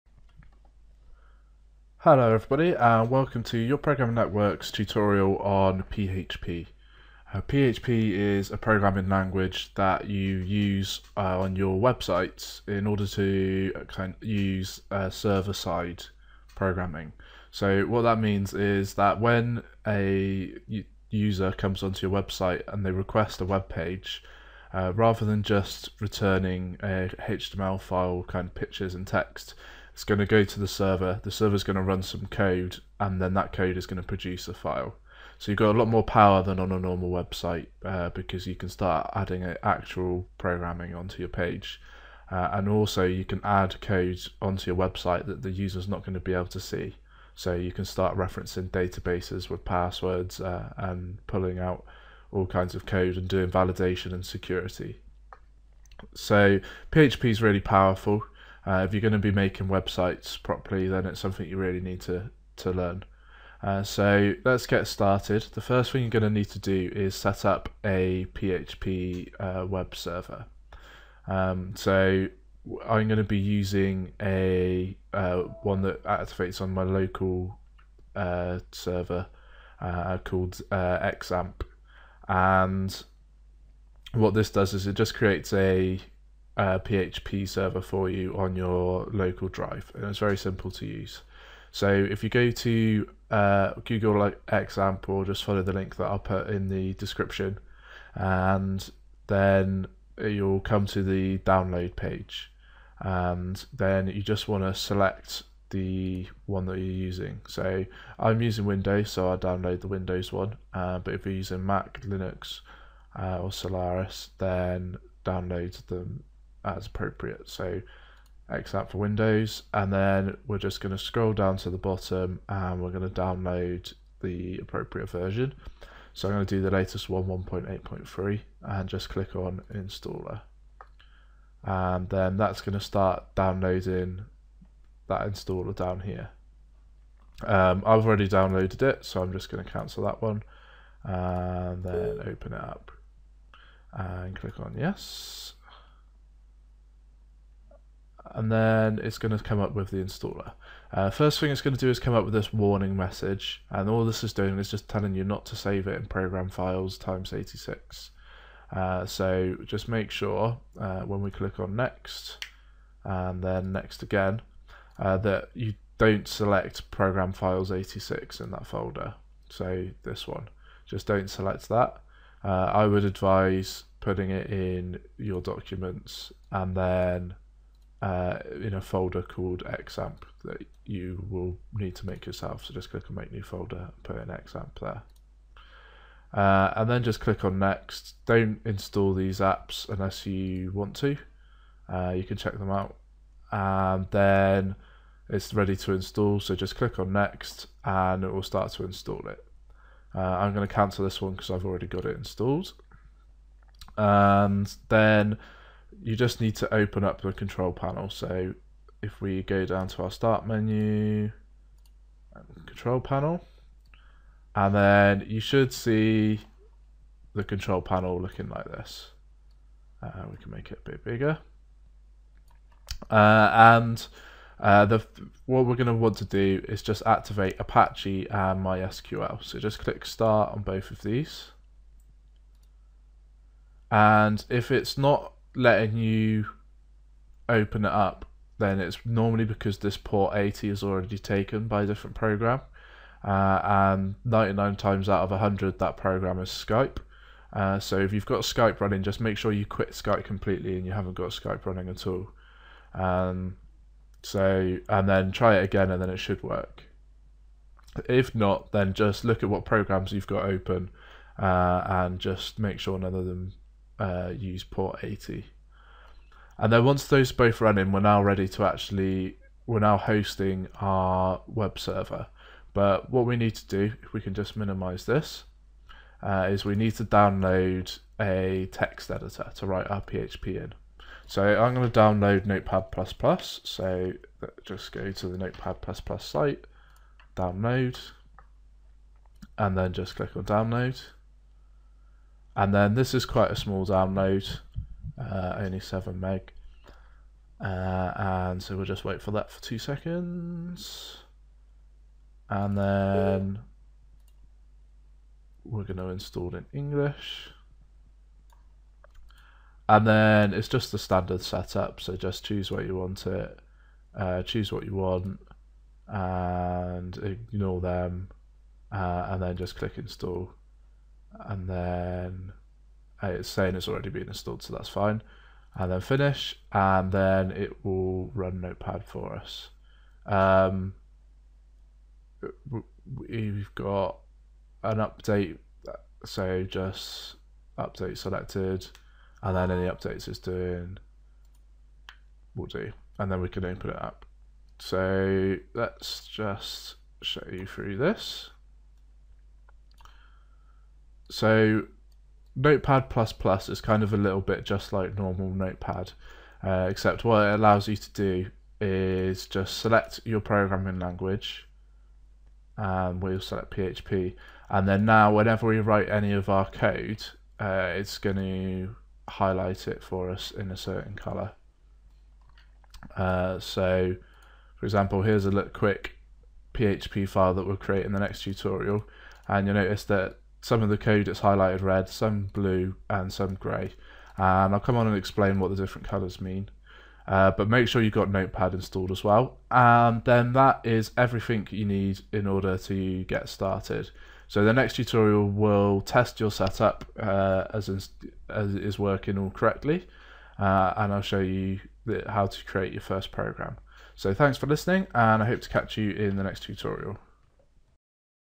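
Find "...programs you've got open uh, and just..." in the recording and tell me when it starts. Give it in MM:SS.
04:19.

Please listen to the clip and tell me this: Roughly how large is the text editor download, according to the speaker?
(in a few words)
7 meg.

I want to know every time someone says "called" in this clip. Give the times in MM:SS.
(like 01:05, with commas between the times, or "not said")
01:20, 02:59.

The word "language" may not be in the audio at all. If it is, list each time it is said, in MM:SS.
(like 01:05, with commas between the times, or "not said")
00:09, 06:00.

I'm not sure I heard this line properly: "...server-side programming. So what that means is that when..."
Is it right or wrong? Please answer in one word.
right.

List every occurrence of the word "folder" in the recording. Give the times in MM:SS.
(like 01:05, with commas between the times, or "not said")
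02:48, 02:58, 03:03.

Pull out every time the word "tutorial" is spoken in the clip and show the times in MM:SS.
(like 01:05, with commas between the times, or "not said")
00:04, 06:18, 06:34, 06:46.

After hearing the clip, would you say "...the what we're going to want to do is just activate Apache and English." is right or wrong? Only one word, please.
wrong.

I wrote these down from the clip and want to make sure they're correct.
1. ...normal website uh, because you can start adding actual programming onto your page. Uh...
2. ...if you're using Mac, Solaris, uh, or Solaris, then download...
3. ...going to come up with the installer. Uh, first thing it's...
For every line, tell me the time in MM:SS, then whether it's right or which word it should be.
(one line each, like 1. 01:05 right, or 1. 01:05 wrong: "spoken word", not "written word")
1. 00:36 right
2. 01:51 wrong: "Linux", not "Solaris"
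3. 02:29 right.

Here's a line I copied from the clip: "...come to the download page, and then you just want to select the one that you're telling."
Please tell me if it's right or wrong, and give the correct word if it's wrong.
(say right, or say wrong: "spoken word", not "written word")
wrong: "using", not "telling".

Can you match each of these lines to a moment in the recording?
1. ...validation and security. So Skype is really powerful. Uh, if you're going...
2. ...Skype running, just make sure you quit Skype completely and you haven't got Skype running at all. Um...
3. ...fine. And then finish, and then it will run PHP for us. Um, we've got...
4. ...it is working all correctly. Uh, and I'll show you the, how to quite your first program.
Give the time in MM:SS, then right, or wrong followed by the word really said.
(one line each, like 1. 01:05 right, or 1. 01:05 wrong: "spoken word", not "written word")
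1. 00:53 wrong: "PHP", not "Skype"
2. 04:08 right
3. 05:24 wrong: "Notepad", not "PHP"
4. 06:38 wrong: "create", not "quite".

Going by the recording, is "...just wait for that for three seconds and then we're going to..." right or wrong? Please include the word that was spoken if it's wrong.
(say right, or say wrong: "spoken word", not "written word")
wrong: "two", not "three".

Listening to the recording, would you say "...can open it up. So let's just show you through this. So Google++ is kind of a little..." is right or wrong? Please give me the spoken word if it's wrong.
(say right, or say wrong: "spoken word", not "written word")
wrong: "Notepad", not "Google".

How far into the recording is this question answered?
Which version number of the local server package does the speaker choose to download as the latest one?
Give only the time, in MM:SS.
02:07.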